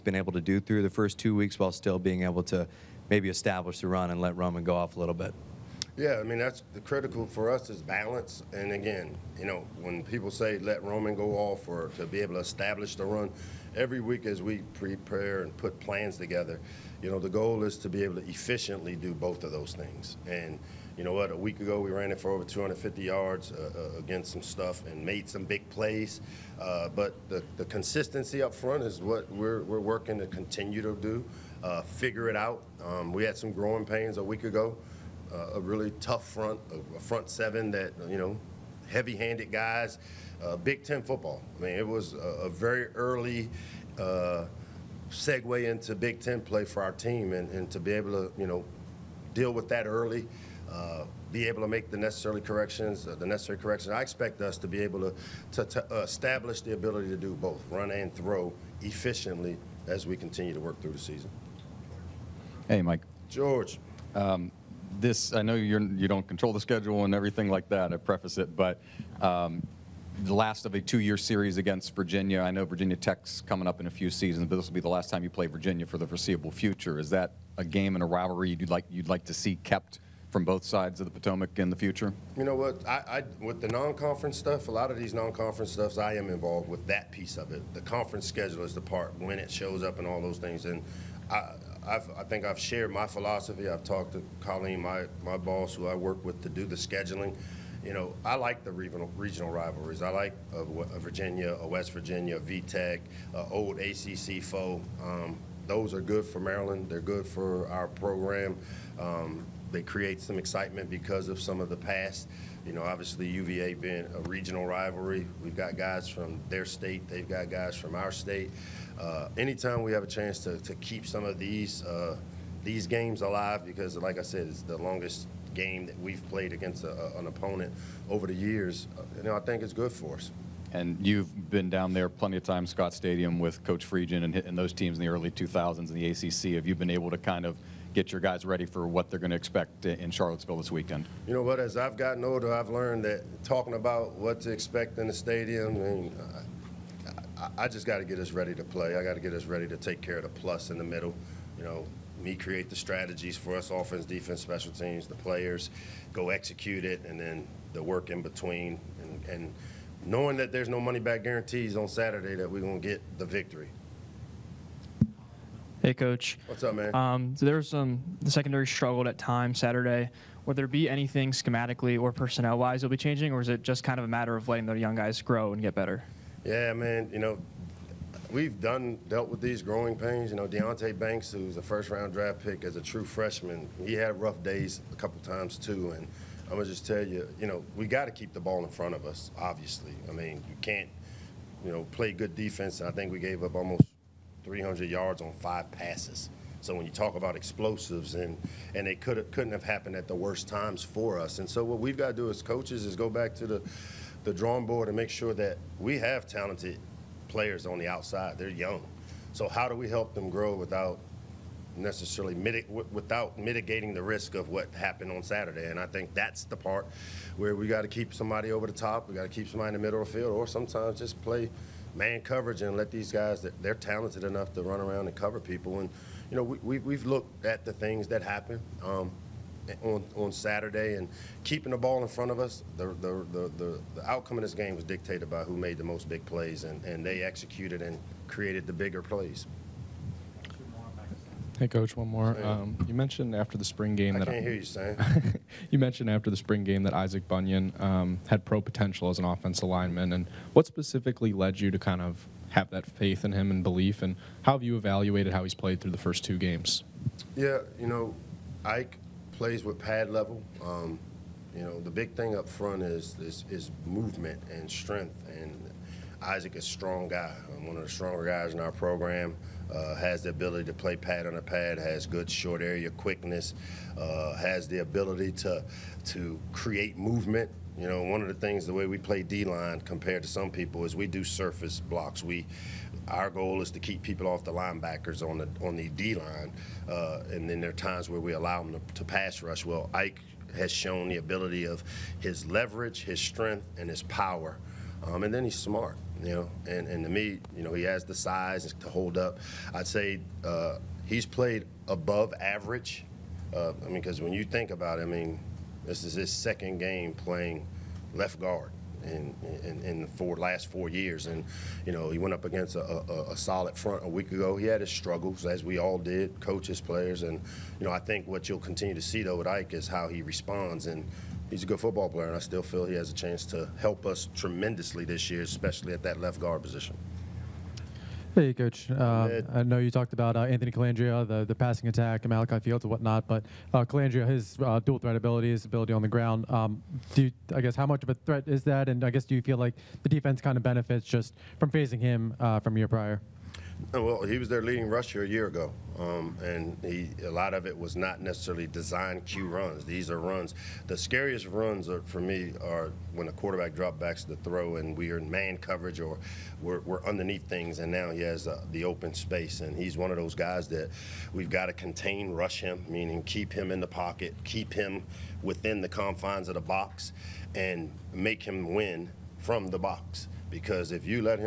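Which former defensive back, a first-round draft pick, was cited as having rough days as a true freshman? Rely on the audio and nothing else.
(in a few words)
Deonte Banks.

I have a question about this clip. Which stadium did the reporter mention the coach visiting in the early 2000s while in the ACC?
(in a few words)
Scott Stadium.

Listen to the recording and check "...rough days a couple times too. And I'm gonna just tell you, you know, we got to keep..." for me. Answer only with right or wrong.
right.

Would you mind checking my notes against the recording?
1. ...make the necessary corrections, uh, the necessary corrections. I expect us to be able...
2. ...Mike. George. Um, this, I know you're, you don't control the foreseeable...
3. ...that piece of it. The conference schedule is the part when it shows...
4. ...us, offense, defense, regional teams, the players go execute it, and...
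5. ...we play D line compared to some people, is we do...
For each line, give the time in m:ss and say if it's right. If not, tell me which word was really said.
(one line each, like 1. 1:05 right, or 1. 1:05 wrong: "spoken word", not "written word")
1. 0:51 right
2. 1:02 wrong: "schedule", not "foreseeable"
3. 1:26 right
4. 2:33 wrong: "special", not "regional"
5. 4:38 right.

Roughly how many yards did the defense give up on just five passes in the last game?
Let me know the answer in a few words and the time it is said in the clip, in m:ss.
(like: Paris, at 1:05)
almost 300, at 3:13.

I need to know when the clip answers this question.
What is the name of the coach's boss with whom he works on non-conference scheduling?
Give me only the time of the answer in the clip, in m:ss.
1:34.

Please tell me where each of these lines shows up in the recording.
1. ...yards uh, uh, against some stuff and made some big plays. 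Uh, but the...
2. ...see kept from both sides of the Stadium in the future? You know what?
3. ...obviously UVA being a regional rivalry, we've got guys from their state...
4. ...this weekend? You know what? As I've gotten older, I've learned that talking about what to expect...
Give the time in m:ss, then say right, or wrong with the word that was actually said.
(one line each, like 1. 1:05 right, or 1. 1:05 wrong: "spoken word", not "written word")
1. 0:23 right
2. 1:19 wrong: "Potomac", not "Stadium"
3. 1:52 right
4. 2:20 right.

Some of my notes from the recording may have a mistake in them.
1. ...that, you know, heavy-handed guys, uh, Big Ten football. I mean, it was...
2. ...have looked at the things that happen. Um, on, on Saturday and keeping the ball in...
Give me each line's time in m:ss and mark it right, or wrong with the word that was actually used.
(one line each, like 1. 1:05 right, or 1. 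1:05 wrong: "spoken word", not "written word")
1. 0:37 right
2. 3:46 right.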